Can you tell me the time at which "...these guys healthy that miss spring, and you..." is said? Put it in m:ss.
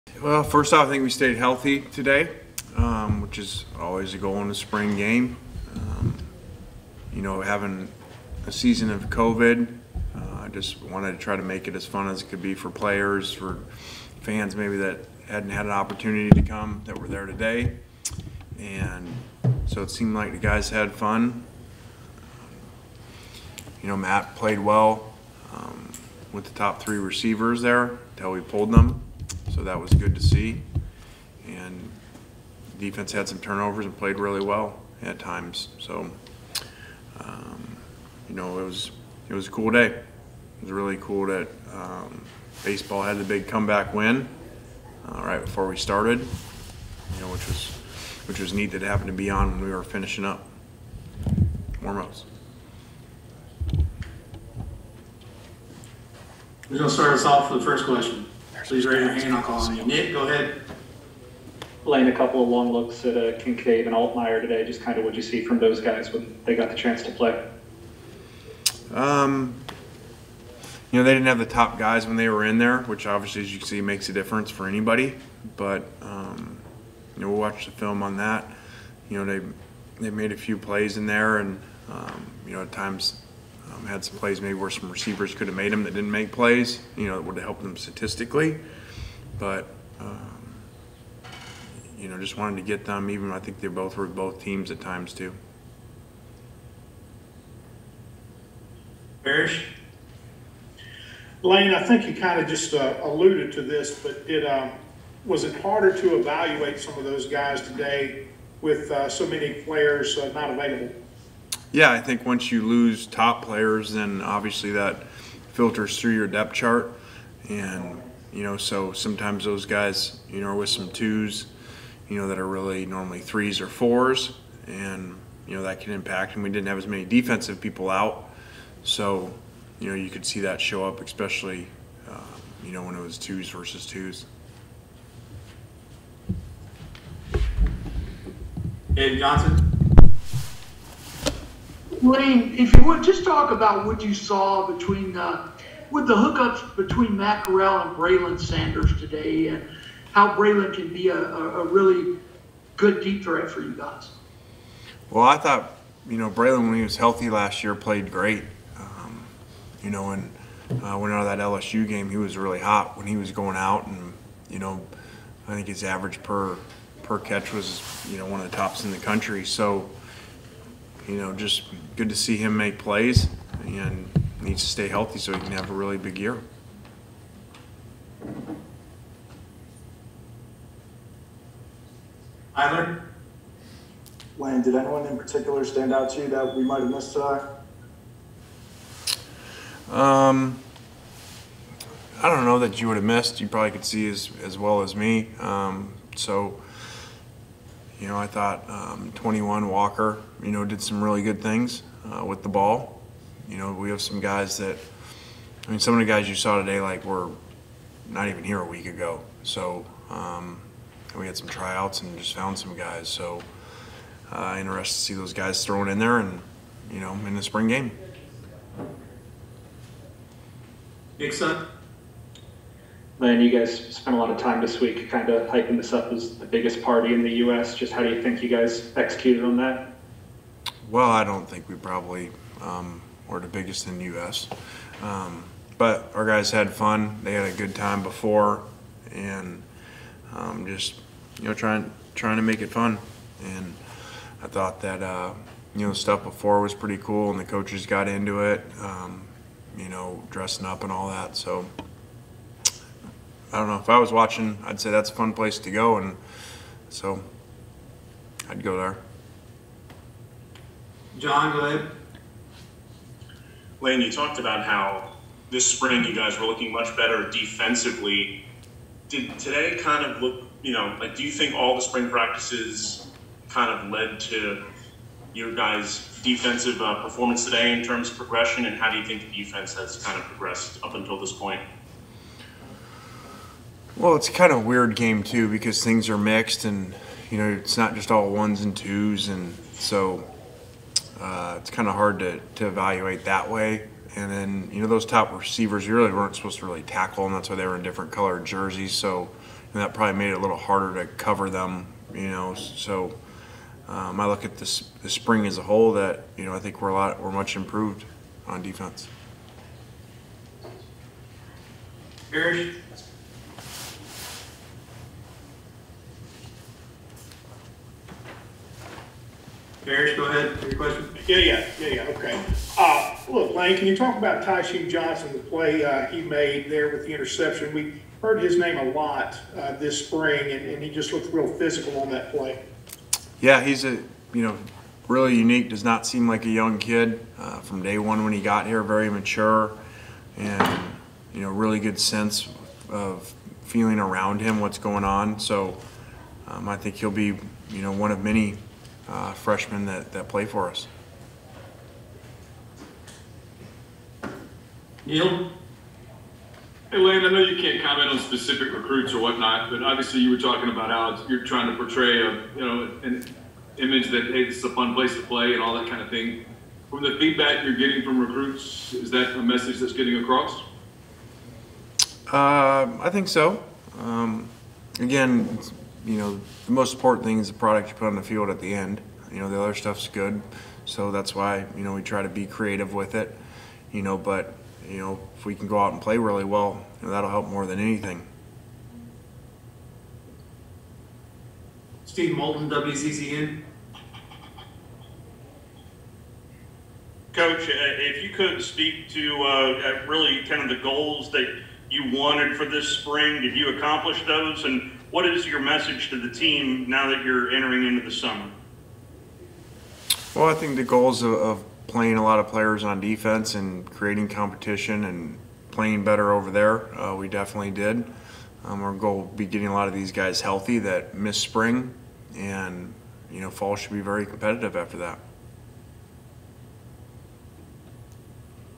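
6:59.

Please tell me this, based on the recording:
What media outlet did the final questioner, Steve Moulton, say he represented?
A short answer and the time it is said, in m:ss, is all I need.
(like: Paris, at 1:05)
WCCN, at 6:32.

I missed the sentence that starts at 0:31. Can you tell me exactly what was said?
And defense had some turnovers and played really well at times.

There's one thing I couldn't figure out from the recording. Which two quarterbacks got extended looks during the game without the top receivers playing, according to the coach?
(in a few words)
Kincaid and Altmyer.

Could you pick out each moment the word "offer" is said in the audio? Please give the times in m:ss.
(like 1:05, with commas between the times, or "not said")
not said.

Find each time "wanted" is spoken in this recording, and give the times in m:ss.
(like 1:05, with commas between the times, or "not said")
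0:10, 1:32, 6:42.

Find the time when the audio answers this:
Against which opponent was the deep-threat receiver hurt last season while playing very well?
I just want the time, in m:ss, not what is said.
2:41.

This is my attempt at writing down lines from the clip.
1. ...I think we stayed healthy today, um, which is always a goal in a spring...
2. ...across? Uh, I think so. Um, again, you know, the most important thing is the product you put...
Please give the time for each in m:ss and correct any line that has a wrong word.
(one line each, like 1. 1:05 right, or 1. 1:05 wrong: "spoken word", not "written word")
1. 0:00 right
2. 6:10 right.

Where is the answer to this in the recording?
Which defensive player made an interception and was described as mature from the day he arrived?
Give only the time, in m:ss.
5:24.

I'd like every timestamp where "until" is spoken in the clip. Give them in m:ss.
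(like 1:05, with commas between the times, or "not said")
0:28, 4:40.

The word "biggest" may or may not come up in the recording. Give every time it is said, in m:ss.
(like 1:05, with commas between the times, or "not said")
3:46, 3:53.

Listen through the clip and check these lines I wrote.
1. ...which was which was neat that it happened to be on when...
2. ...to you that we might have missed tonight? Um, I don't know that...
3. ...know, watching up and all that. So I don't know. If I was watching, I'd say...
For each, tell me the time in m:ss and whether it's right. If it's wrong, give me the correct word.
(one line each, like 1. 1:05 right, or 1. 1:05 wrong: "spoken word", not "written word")
1. 0:47 right
2. 3:06 right
3. 4:09 wrong: "dressing", not "watching".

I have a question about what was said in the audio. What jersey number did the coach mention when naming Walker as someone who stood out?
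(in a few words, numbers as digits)
21.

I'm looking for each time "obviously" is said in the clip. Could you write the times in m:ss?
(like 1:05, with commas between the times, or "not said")
1:13, 1:54, 5:59.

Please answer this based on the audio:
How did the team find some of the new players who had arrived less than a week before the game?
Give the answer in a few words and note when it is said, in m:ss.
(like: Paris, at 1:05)
Tryouts, at 3:31.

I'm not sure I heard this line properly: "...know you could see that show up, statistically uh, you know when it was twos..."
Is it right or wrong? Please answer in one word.
wrong.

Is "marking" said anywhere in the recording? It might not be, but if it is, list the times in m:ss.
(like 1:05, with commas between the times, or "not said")
not said.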